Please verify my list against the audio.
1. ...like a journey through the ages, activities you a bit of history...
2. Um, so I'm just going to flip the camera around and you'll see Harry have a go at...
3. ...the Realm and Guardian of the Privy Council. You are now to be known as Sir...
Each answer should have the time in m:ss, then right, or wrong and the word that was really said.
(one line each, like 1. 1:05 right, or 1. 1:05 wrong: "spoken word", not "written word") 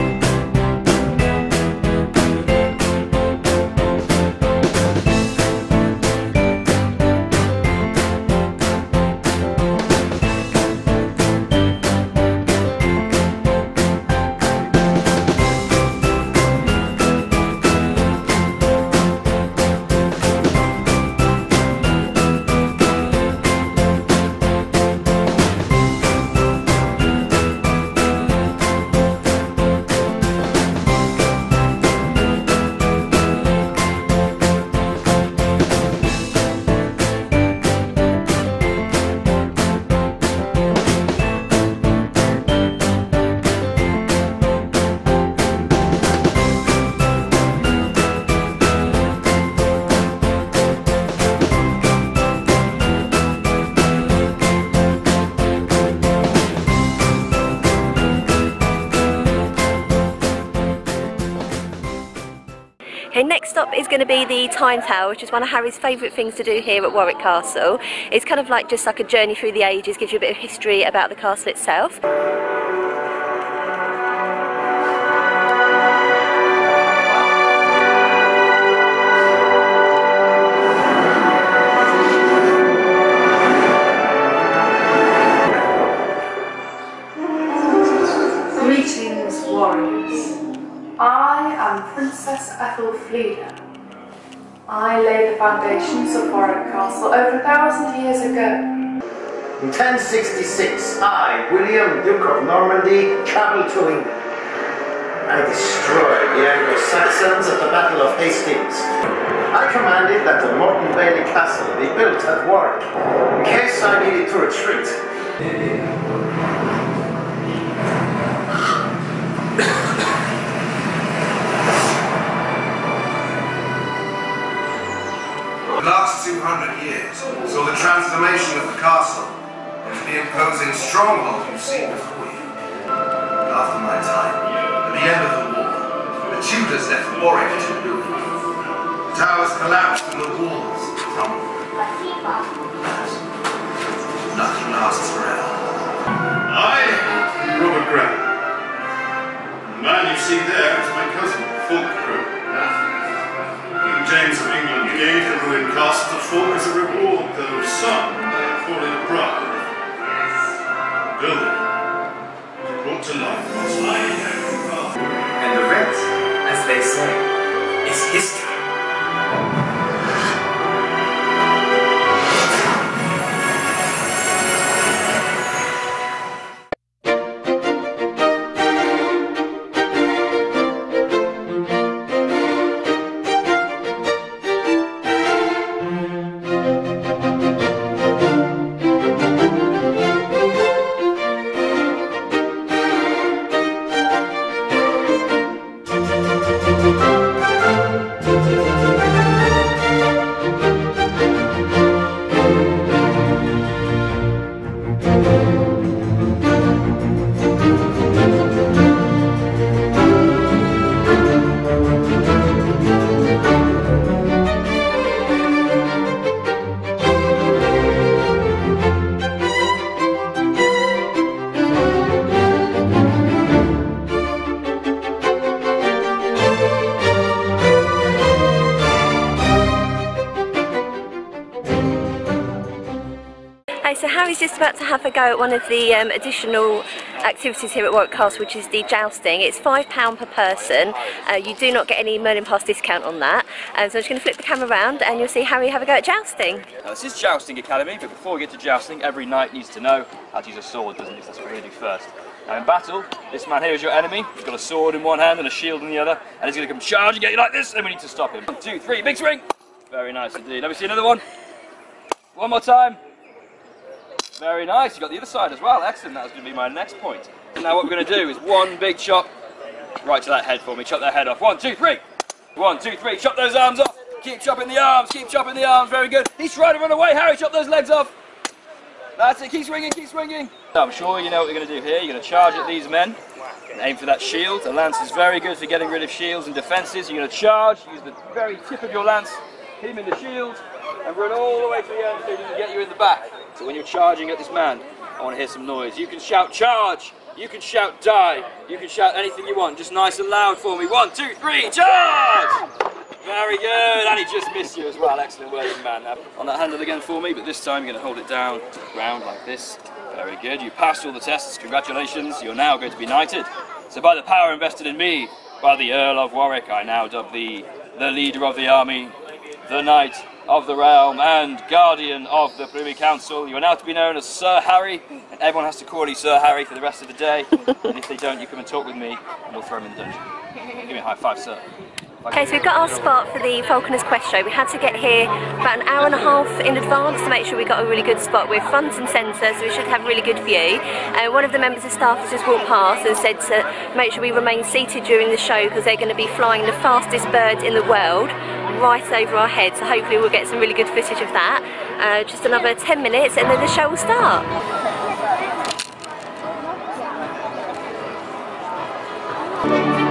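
1. 1:08 wrong: "gives", not "activities"
2. 4:03 right
3. 5:20 right.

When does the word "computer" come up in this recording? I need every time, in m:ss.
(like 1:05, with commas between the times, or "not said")
not said.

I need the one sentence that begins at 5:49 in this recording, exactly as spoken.
So hopefully we'll get some really good footage of that.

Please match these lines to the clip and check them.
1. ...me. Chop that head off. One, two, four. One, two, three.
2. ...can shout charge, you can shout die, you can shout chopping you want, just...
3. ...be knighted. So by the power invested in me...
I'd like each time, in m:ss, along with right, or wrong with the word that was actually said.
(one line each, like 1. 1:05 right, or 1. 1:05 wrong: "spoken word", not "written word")
1. 4:30 wrong: "three", not "four"
2. 4:56 wrong: "anything", not "chopping"
3. 5:12 right.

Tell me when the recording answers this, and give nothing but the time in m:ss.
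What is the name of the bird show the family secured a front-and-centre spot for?
5:33.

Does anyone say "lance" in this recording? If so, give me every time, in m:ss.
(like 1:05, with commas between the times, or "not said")
4:44, 4:49.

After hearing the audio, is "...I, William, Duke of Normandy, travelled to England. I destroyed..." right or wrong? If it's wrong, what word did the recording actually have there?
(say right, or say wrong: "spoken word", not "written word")
right.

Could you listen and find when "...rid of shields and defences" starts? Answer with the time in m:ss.
4:45.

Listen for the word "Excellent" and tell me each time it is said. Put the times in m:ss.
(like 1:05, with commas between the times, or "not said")
4:25, 5:05.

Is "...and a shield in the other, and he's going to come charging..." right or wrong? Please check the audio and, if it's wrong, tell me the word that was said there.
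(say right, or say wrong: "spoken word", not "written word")
right.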